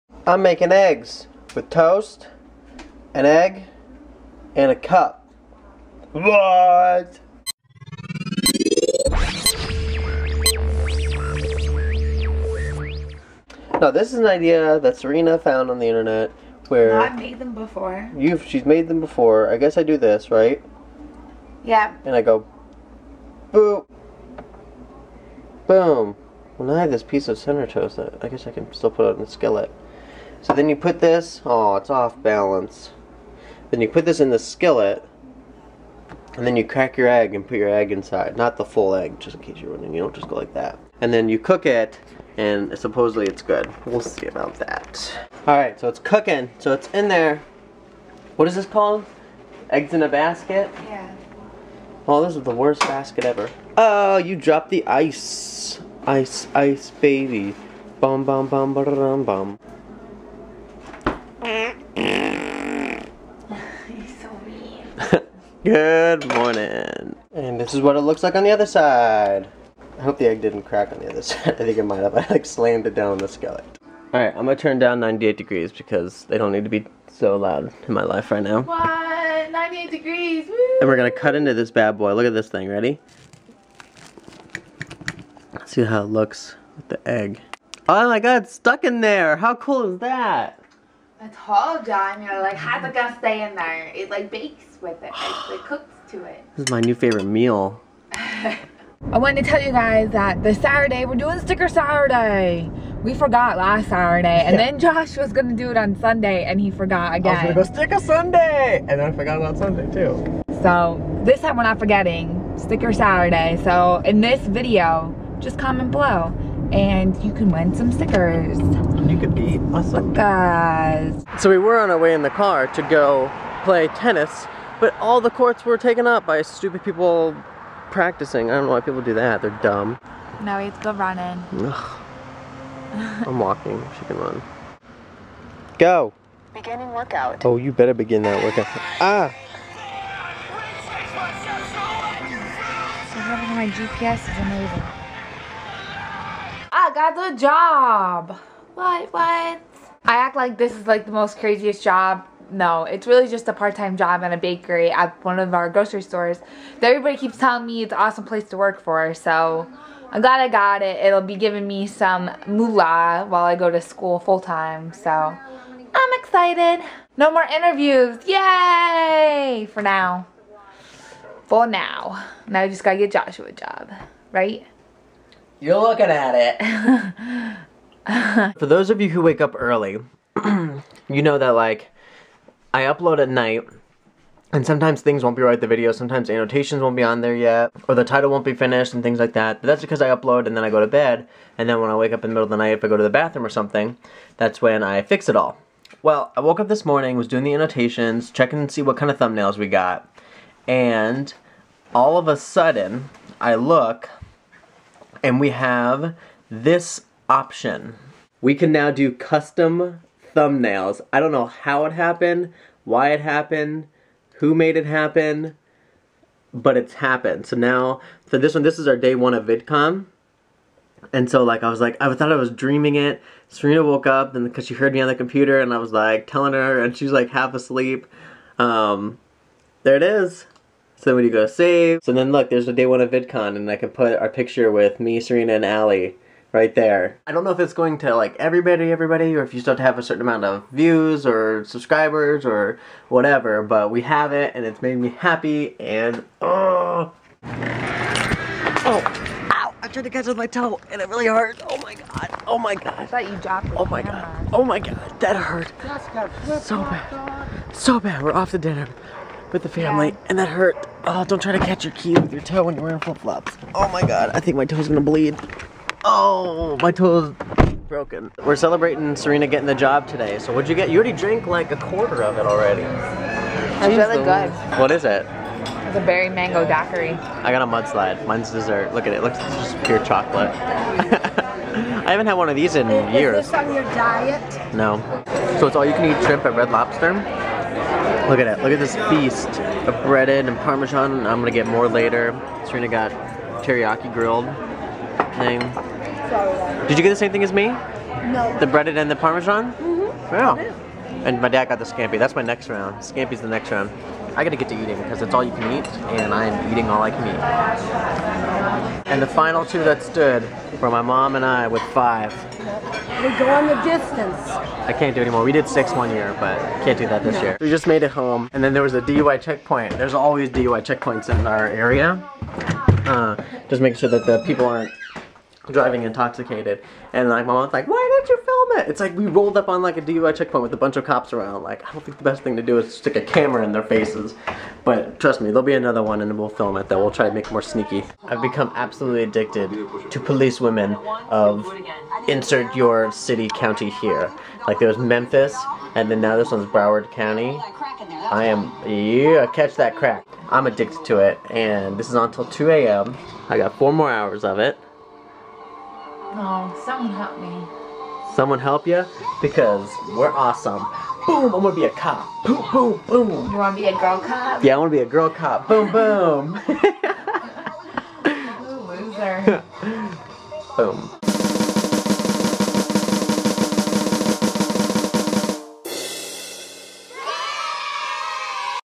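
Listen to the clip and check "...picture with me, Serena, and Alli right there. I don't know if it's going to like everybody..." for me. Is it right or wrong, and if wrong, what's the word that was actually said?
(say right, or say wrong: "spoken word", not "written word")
right.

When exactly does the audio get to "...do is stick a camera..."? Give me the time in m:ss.
5:32.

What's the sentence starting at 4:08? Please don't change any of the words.
Oh, ow, I tried to catch with my toe and it really hurt.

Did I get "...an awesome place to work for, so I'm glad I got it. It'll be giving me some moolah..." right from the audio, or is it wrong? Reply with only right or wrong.
right.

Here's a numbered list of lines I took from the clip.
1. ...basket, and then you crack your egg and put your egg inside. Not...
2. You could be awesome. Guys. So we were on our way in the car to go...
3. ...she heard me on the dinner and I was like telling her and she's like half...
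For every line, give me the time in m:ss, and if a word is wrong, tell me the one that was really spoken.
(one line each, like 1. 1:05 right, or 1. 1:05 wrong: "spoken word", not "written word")
1. 0:34 wrong: "skillet", not "basket"
2. 1:58 right
3. 3:44 wrong: "computer", not "dinner".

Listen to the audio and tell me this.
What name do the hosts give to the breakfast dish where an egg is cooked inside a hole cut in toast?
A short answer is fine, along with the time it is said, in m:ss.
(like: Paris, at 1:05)
Eggs in a basket, at 0:49.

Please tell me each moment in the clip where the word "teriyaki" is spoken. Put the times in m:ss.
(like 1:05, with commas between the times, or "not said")
4:53.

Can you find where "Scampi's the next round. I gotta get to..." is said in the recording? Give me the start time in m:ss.
5:03.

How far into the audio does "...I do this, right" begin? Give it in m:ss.
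0:19.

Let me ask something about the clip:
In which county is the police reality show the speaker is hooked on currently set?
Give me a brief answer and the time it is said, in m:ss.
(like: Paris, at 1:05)
Broward County, at 5:46.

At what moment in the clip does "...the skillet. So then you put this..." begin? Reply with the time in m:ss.
0:29.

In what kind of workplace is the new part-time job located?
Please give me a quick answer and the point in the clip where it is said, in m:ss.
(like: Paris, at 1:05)
A bakery, at 2:34.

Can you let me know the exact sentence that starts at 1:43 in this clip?
We forgot last Saturday, and yeah.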